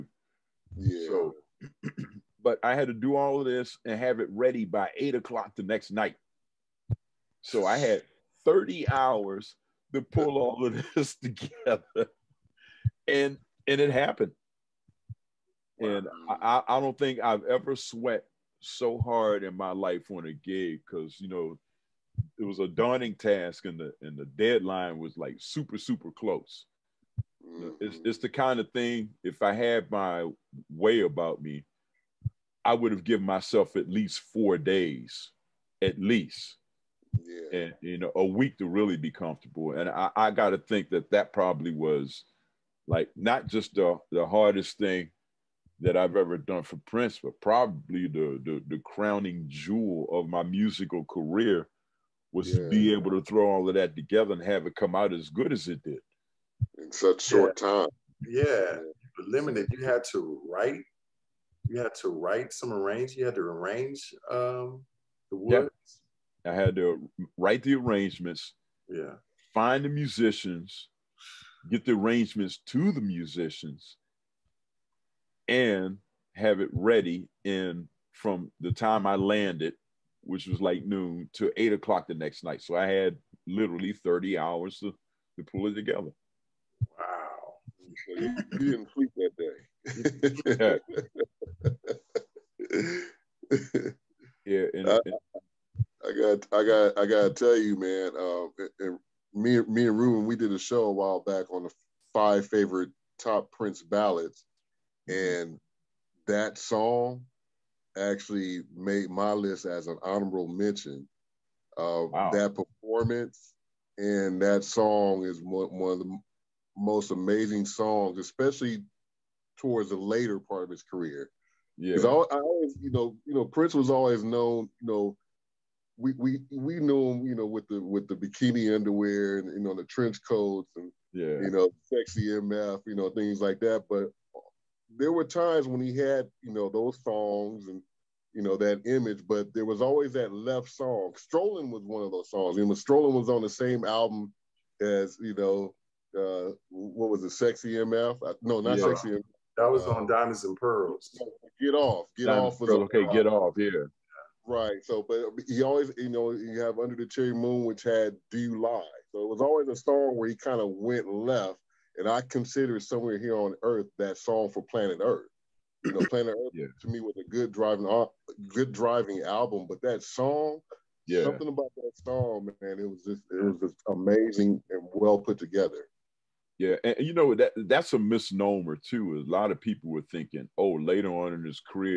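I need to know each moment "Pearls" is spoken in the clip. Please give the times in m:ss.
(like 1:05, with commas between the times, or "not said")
2:30.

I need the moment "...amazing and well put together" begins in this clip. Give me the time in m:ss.
2:53.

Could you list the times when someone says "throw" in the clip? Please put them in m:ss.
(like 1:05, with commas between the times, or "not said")
0:53.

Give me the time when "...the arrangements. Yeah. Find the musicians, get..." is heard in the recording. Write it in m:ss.
1:07.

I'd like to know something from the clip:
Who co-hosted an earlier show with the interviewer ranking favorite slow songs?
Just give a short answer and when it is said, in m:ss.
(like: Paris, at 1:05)
Ruben, at 1:39.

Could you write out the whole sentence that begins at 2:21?
Strolling was one of those songs.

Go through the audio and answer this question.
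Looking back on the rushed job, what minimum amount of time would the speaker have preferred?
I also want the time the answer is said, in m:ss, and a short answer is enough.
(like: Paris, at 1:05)
4 days, at 0:34.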